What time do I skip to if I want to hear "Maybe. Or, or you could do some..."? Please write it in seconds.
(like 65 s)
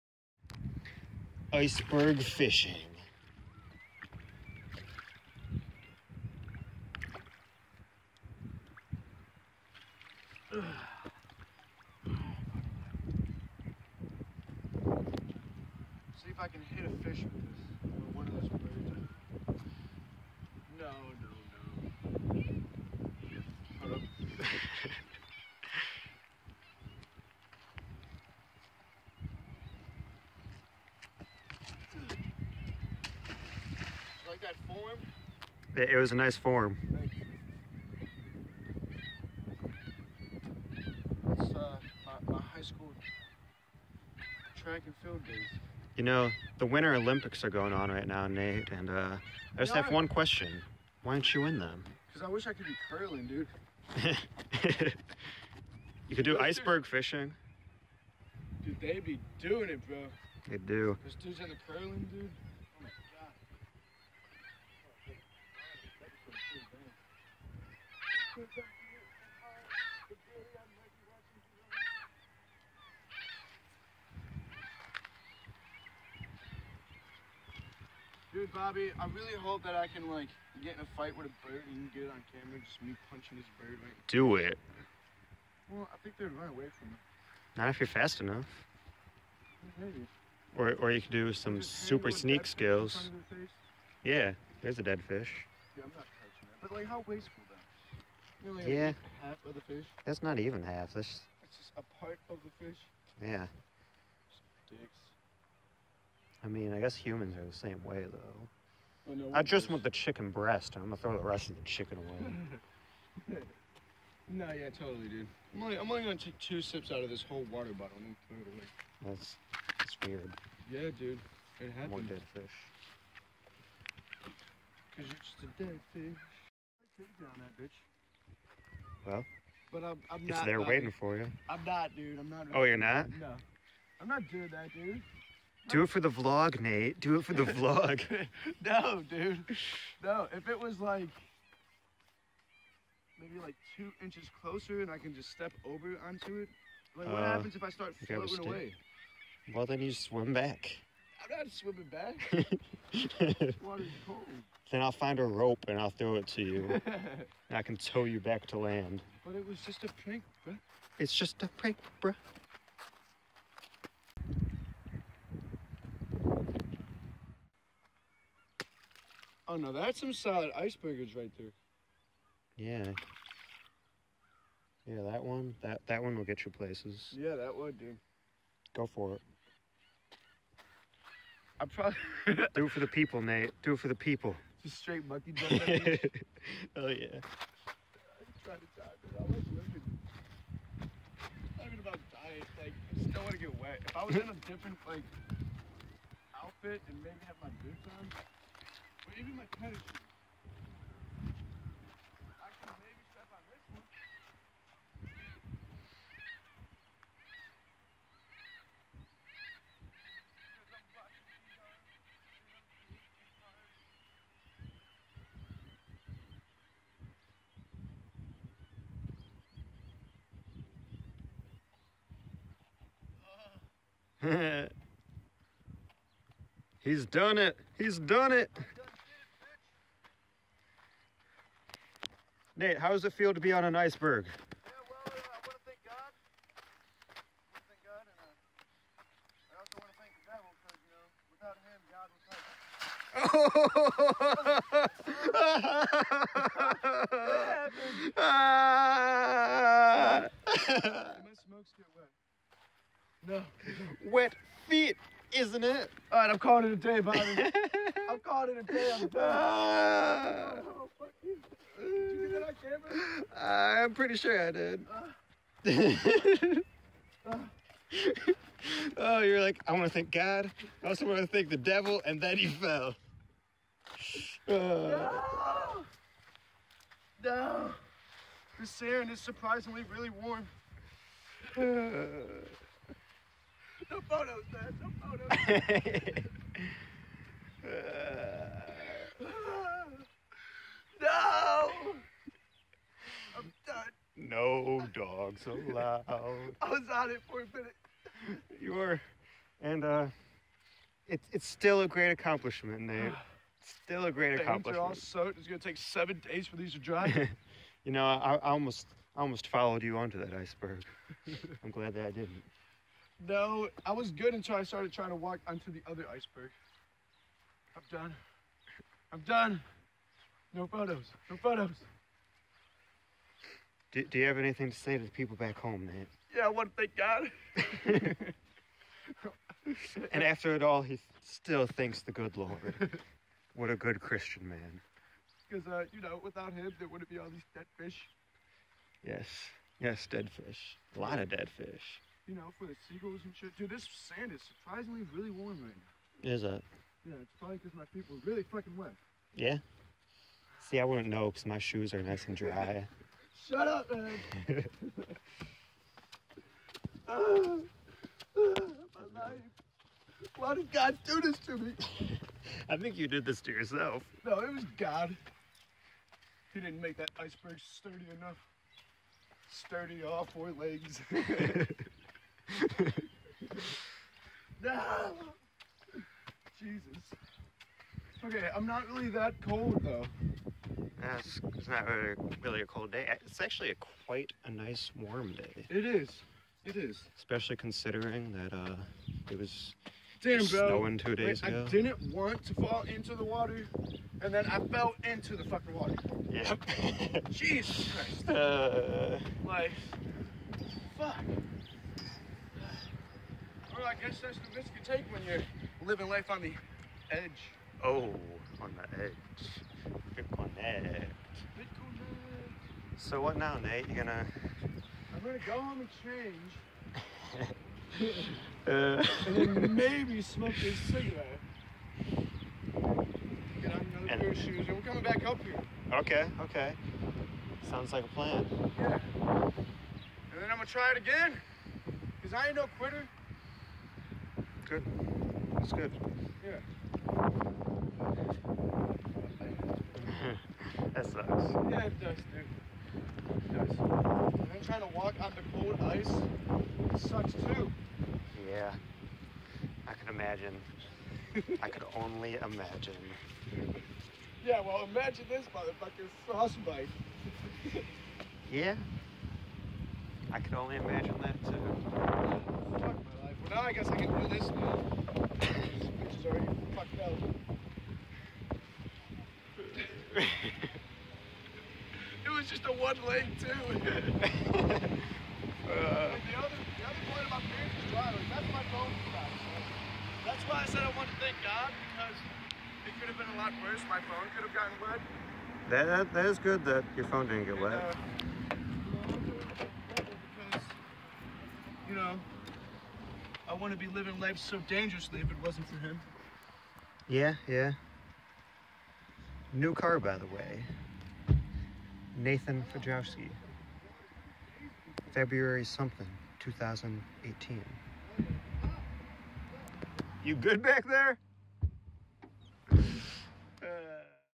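89 s.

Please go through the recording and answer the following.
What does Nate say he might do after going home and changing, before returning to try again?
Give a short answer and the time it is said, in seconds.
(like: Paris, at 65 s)
Smoke a cigarette, at 420 s.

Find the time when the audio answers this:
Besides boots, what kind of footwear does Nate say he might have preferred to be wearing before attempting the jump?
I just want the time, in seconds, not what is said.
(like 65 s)
199 s.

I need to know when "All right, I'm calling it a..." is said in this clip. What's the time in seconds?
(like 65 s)
256 s.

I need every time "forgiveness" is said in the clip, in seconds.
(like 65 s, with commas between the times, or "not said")
not said.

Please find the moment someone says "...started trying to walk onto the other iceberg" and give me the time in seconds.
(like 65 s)
314 s.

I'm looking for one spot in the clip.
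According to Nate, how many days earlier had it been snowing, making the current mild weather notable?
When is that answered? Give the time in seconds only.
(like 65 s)
390 s.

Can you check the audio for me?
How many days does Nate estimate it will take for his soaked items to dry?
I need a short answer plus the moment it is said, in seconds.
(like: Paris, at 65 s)
7, at 305 s.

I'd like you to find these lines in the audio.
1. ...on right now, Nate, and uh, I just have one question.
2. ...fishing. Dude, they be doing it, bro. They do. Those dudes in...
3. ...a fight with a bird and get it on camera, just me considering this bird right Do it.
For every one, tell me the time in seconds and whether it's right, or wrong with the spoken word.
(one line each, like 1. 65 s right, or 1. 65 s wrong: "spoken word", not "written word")
1. 47 s right
2. 56 s right
3. 80 s wrong: "punching", not "considering".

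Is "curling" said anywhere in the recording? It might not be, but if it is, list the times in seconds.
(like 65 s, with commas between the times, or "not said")
52 s, 61 s.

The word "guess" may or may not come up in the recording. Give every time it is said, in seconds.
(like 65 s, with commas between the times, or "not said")
106 s, 403 s, 463 s.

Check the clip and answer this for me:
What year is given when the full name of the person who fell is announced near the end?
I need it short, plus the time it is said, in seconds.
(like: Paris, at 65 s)
2018, at 506 s.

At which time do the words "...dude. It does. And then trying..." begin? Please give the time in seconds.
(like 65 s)
442 s.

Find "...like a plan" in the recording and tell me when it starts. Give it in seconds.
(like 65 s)
427 s.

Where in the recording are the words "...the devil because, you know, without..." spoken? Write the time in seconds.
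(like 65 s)
250 s.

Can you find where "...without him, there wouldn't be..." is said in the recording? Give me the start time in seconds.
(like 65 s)
336 s.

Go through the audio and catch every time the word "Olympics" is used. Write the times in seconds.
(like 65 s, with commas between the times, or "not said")
46 s.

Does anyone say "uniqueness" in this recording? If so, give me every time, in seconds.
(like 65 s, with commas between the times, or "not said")
not said.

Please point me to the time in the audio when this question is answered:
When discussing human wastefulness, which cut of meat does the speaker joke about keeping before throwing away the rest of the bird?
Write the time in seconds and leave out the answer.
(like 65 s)
109 s.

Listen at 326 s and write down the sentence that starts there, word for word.
Yeah, I want to thank God.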